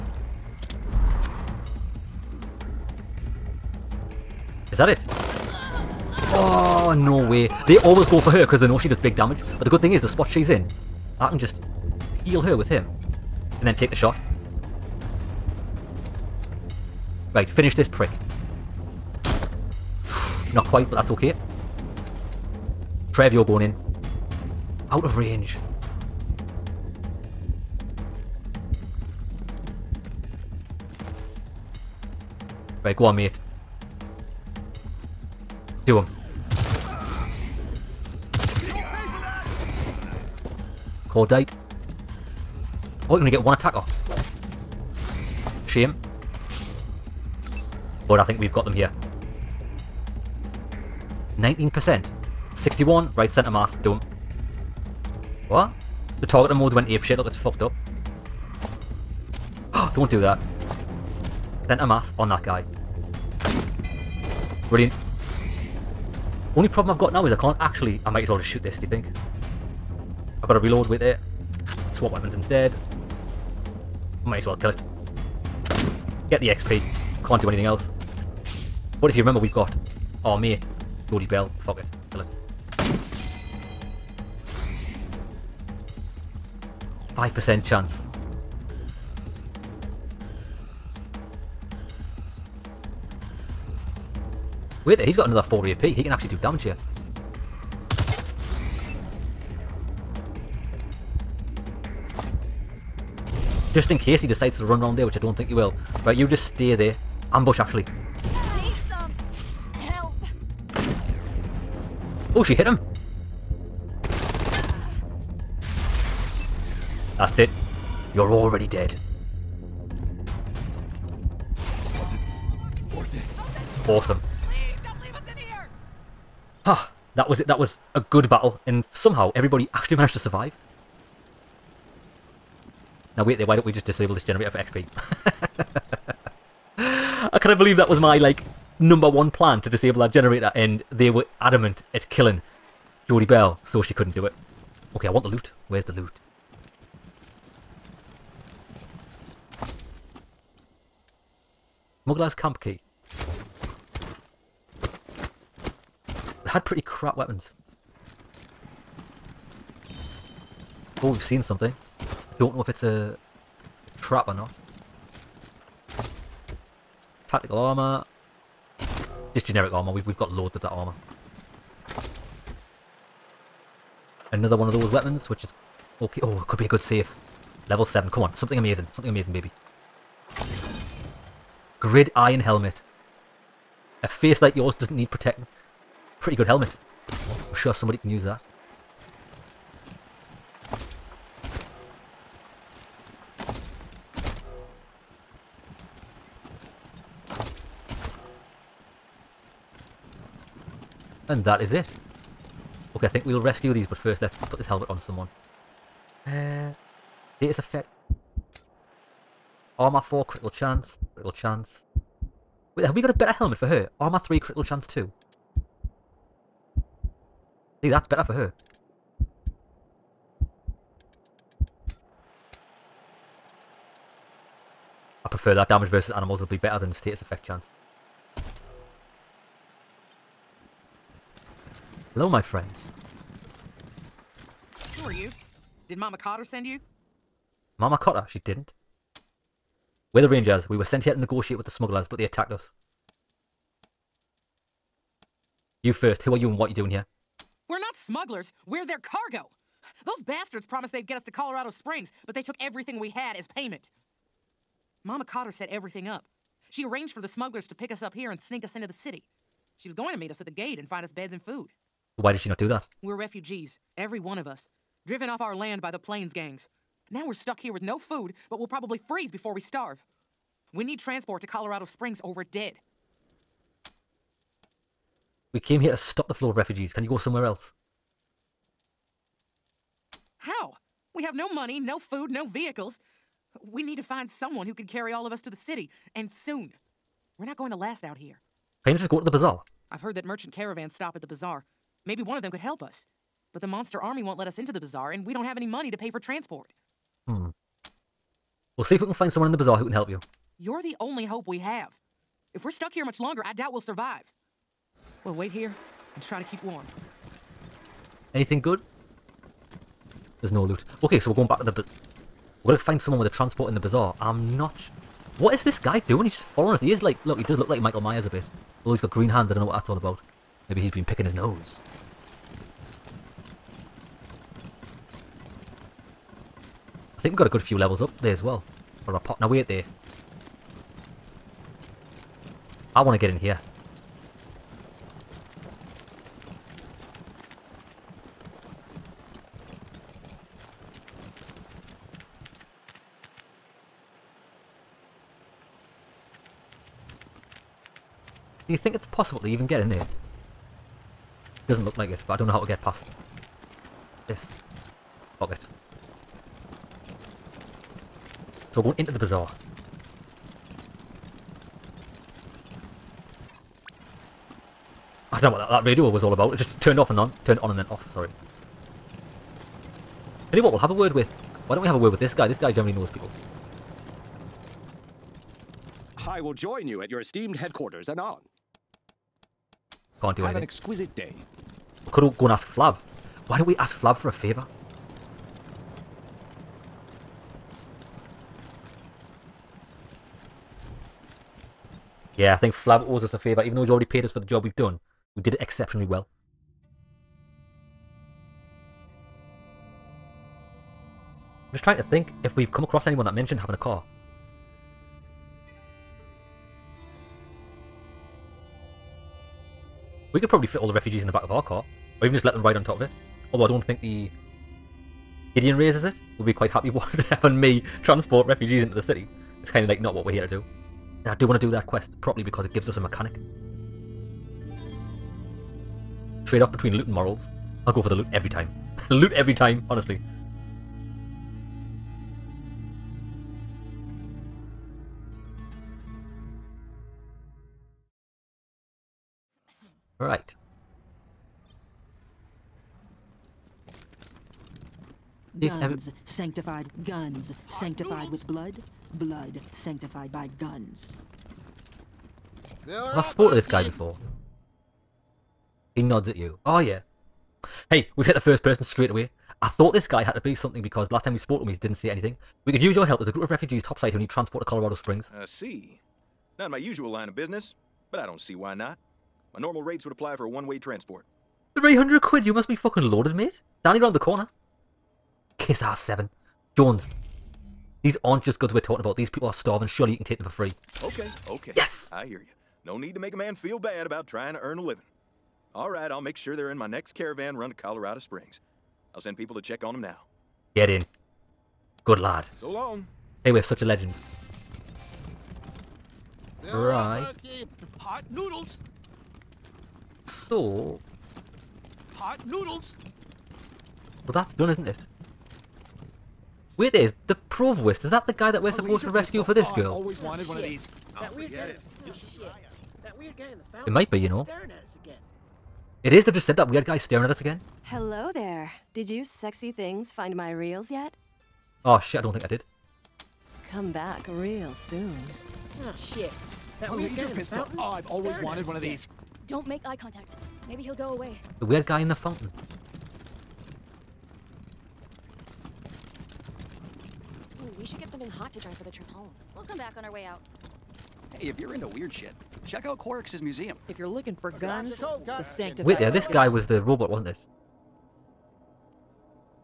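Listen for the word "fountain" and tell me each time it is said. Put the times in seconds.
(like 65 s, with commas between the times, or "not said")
513 s, 532 s.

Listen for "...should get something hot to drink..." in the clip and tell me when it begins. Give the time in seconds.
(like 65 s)
537 s.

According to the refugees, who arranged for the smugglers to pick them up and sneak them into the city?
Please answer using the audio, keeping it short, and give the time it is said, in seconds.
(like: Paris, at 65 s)
Mama Cotter, at 255 s.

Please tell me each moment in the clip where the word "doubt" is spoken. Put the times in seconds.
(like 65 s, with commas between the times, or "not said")
303 s.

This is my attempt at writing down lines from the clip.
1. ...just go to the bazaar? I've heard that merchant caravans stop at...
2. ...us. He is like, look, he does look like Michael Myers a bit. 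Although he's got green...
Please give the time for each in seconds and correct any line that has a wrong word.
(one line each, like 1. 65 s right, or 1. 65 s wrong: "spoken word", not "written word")
1. 288 s right
2. 316 s right.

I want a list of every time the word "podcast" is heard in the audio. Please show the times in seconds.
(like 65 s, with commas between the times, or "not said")
not said.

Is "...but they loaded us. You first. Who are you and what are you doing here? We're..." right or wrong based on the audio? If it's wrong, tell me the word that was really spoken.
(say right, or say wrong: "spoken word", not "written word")
wrong: "attacked", not "loaded".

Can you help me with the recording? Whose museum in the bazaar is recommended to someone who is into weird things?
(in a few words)
Quorix.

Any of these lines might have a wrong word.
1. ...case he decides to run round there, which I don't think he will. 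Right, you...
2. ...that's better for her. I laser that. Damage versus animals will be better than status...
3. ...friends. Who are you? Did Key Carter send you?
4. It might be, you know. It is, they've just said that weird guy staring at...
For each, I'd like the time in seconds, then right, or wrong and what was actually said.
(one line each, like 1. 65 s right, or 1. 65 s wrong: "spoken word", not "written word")
1. 103 s right
2. 217 s wrong: "prefer", not "laser"
3. 232 s wrong: "Mama", not "Key"
4. 513 s right.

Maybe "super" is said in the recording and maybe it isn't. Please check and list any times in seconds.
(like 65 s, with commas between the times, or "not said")
not said.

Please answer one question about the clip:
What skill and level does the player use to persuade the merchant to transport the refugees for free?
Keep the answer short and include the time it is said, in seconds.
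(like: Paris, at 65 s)
Kiss ass 7, at 475 s.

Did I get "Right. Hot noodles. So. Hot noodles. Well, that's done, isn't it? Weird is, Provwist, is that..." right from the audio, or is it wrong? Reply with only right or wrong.
right.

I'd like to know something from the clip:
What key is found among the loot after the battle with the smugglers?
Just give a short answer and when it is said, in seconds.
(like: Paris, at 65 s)
Smuggler's Camp Key, at 152 s.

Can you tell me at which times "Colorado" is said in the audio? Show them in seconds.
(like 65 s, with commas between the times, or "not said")
251 s, 271 s, 464 s, 487 s.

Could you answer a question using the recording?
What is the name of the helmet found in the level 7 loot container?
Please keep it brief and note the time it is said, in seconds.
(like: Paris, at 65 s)
Grid iron helmet, at 181 s.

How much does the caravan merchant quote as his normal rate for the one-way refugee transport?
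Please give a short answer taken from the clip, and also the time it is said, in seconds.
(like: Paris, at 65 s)
300, at 471 s.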